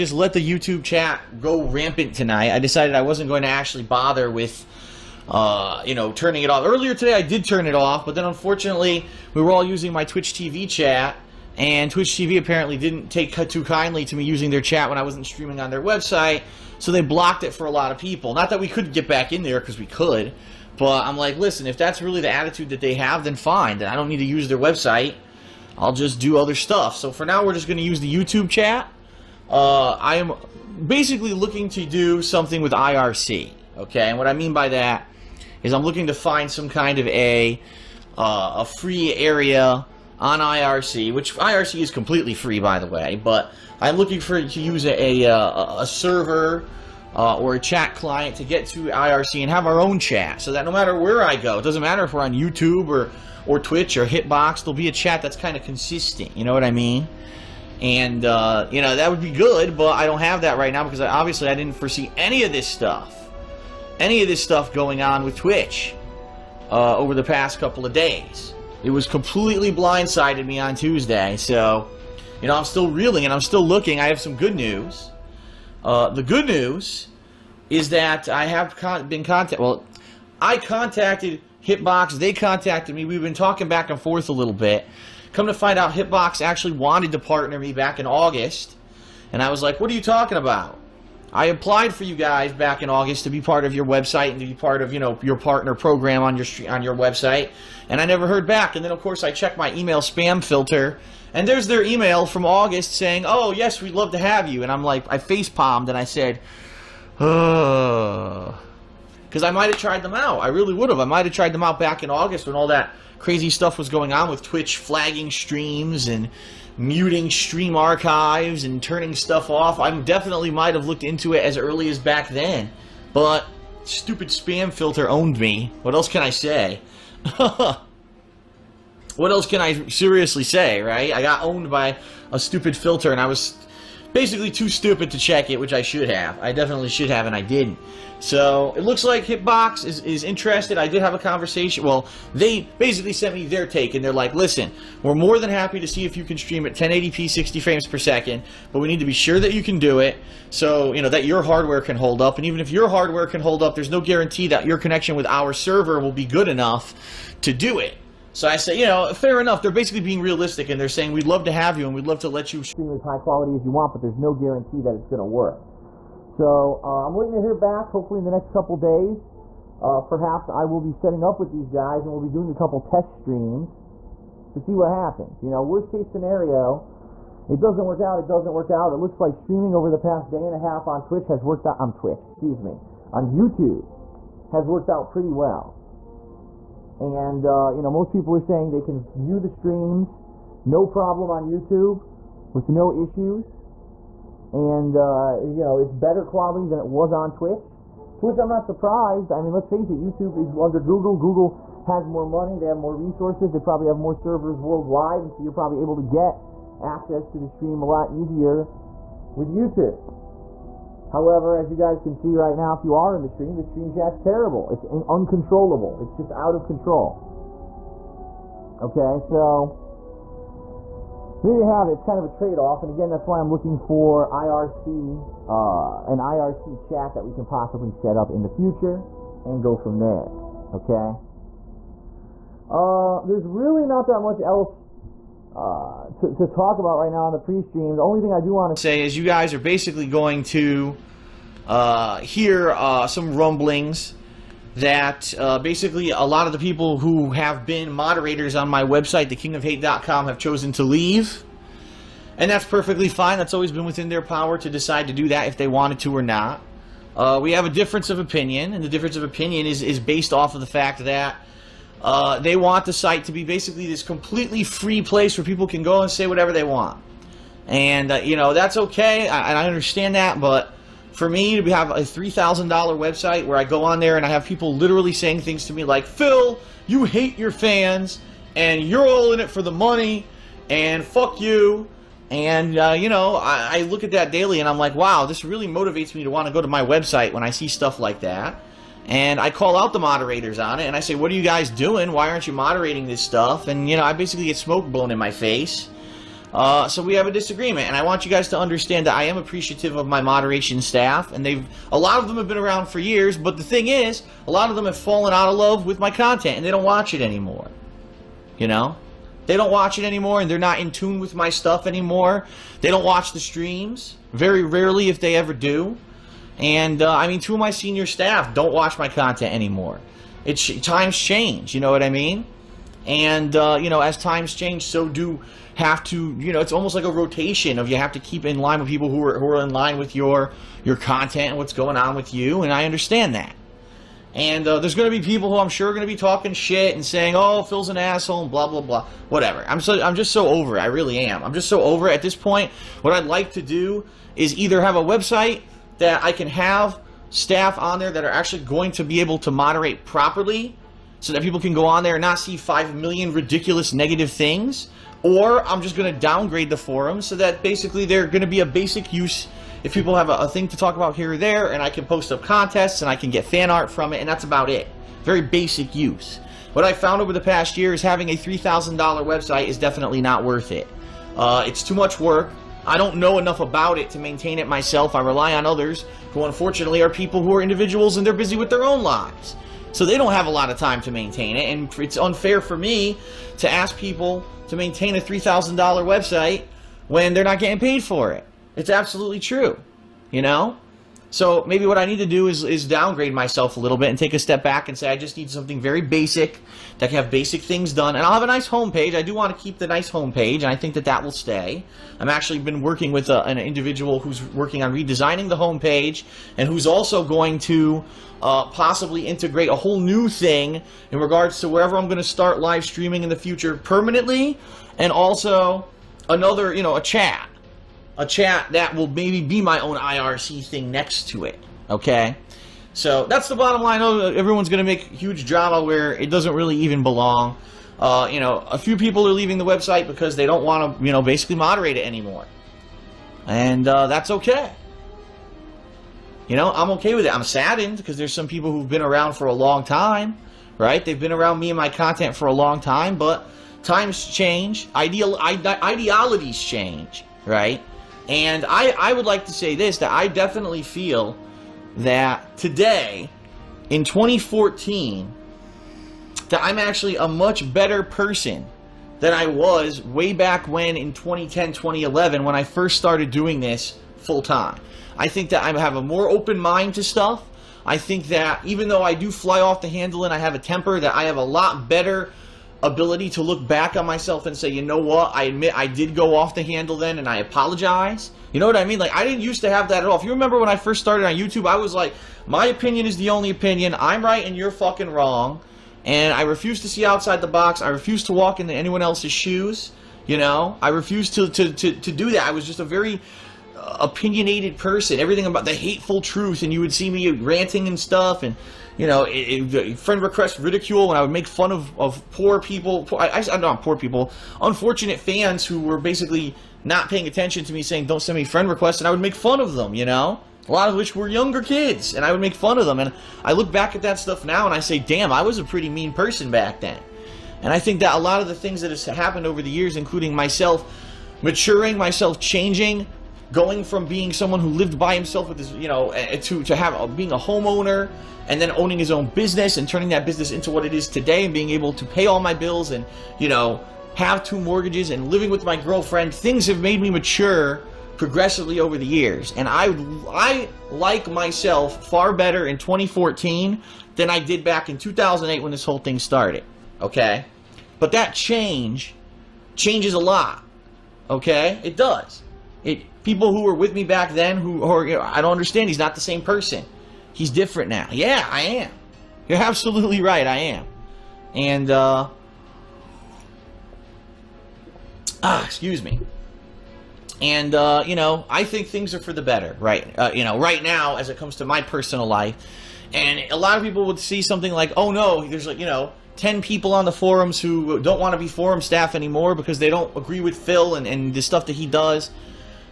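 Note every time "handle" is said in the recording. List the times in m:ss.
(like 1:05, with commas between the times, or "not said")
7:49, 7:56.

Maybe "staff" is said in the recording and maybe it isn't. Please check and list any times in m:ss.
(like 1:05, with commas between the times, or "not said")
5:00, 5:18, 5:47, 9:38.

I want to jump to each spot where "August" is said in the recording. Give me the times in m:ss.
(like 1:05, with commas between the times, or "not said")
1:28, 1:32, 1:42, 1:52.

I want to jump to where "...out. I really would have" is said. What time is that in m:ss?
1:50.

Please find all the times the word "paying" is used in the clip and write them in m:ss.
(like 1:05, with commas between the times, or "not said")
8:27.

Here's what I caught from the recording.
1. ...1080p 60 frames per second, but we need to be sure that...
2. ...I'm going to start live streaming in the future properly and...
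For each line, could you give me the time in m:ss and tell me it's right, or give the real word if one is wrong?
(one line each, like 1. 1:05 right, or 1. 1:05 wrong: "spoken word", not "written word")
1. 2:26 right
2. 6:51 wrong: "permanently", not "properly".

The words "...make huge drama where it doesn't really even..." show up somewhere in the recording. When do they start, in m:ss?
7:04.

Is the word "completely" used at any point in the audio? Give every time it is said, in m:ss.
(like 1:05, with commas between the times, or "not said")
0:41, 1:09, 4:24.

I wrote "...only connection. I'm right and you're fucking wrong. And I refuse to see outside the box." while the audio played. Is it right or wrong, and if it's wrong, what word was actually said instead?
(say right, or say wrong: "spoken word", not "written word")
wrong: "opinion", not "connection".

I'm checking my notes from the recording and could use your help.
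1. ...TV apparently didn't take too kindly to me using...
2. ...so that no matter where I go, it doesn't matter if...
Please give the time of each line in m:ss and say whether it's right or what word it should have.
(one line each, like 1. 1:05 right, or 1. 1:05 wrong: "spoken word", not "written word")
1. 0:12 right
2. 0:50 right.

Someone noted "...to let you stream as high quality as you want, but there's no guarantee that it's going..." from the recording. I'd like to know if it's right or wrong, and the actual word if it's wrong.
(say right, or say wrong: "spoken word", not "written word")
right.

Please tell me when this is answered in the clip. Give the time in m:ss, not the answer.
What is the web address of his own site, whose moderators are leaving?
4:09.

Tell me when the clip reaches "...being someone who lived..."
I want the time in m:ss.
8:44.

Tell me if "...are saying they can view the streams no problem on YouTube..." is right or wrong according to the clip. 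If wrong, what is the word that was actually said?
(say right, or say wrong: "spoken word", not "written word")
right.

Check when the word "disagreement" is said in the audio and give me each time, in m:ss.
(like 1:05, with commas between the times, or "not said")
4:57.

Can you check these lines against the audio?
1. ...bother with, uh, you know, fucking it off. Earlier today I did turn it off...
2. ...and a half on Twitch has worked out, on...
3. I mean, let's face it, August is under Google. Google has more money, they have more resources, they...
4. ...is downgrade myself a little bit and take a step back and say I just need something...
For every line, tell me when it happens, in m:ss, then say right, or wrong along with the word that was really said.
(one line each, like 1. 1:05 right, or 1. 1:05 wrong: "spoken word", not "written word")
1. 0:03 wrong: "turning", not "fucking"
2. 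3:00 right
3. 3:19 wrong: "YouTube", not "August"
4. 6:32 right.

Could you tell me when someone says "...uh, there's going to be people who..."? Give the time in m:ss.
5:34.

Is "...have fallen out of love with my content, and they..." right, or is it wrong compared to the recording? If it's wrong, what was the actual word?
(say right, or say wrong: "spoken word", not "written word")
right.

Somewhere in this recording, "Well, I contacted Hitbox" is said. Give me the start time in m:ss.
1:19.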